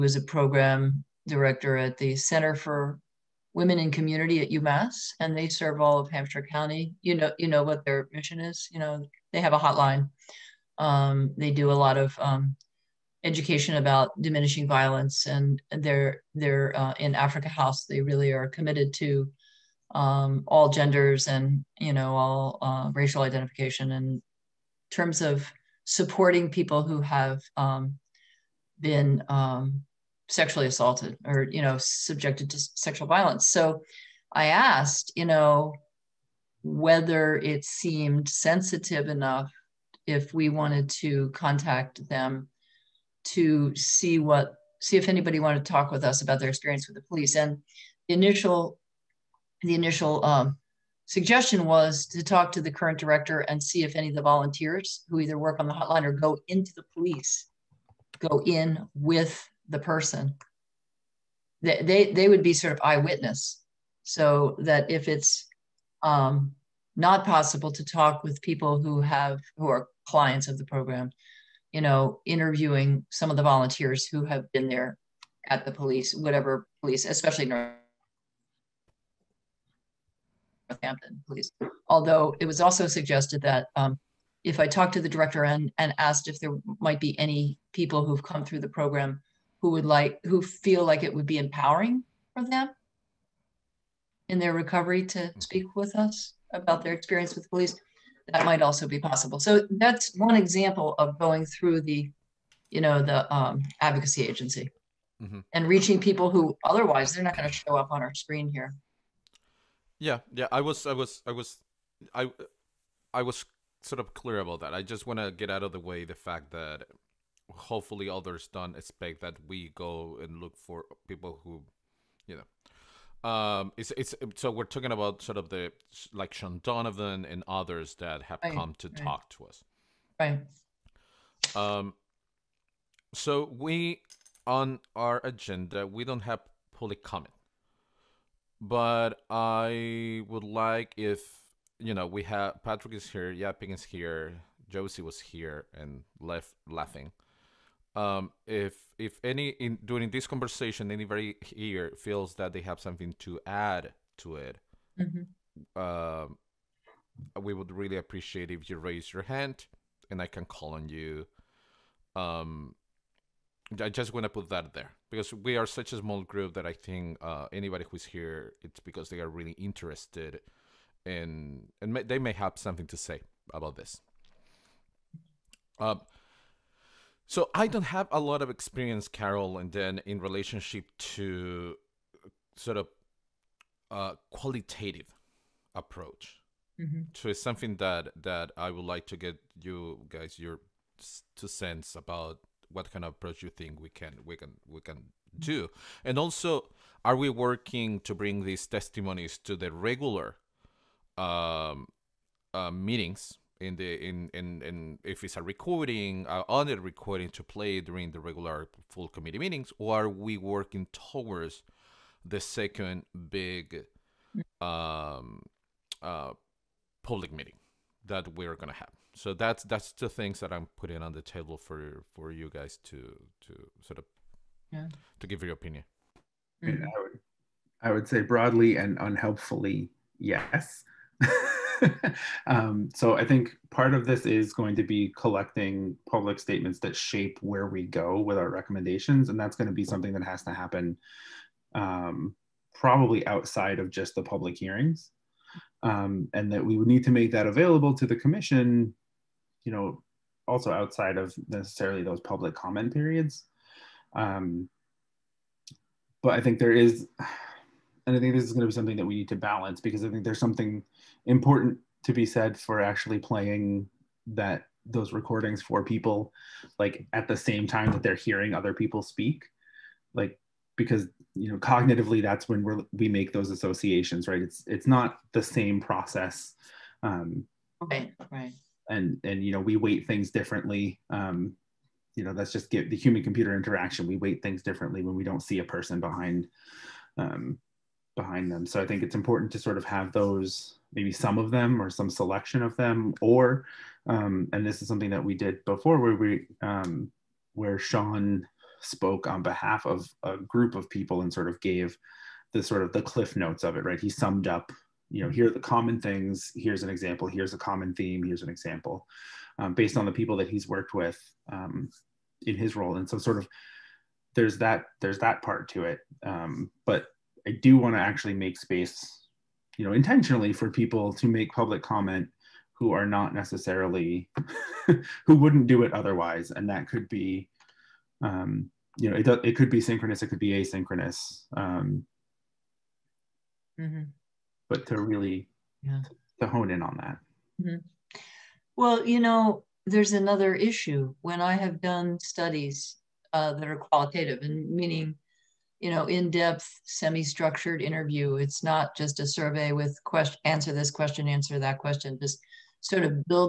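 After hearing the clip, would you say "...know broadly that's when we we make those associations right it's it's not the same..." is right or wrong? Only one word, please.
wrong.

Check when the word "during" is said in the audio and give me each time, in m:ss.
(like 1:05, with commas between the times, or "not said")
2:29, 3:27.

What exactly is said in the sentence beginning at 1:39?
So that's one example of going through the, you know, the um, advocacy agency mm-hmm.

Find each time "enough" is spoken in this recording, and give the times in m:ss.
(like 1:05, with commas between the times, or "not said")
0:39.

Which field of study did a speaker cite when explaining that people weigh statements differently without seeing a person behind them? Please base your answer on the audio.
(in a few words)
human computer interaction.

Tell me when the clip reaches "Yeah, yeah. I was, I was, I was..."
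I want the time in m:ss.
1:49.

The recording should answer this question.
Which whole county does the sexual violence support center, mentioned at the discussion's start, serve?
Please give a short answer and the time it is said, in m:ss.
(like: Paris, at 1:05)
Hampshire County, at 0:06.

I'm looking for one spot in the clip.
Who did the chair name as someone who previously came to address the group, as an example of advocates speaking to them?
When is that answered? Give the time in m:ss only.
2:06.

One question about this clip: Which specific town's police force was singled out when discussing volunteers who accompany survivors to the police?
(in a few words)
Northampton.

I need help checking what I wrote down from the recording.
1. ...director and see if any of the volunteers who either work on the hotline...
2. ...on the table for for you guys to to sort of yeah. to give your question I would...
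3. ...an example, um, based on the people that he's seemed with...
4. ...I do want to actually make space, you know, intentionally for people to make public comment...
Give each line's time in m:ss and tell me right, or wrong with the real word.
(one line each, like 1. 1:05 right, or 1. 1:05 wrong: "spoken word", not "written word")
1. 0:52 right
2. 3:41 wrong: "opinion", not "question"
3. 5:08 wrong: "worked", not "seemed"
4. 5:17 right.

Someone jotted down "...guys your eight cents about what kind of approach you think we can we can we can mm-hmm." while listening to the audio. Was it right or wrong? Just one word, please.
wrong.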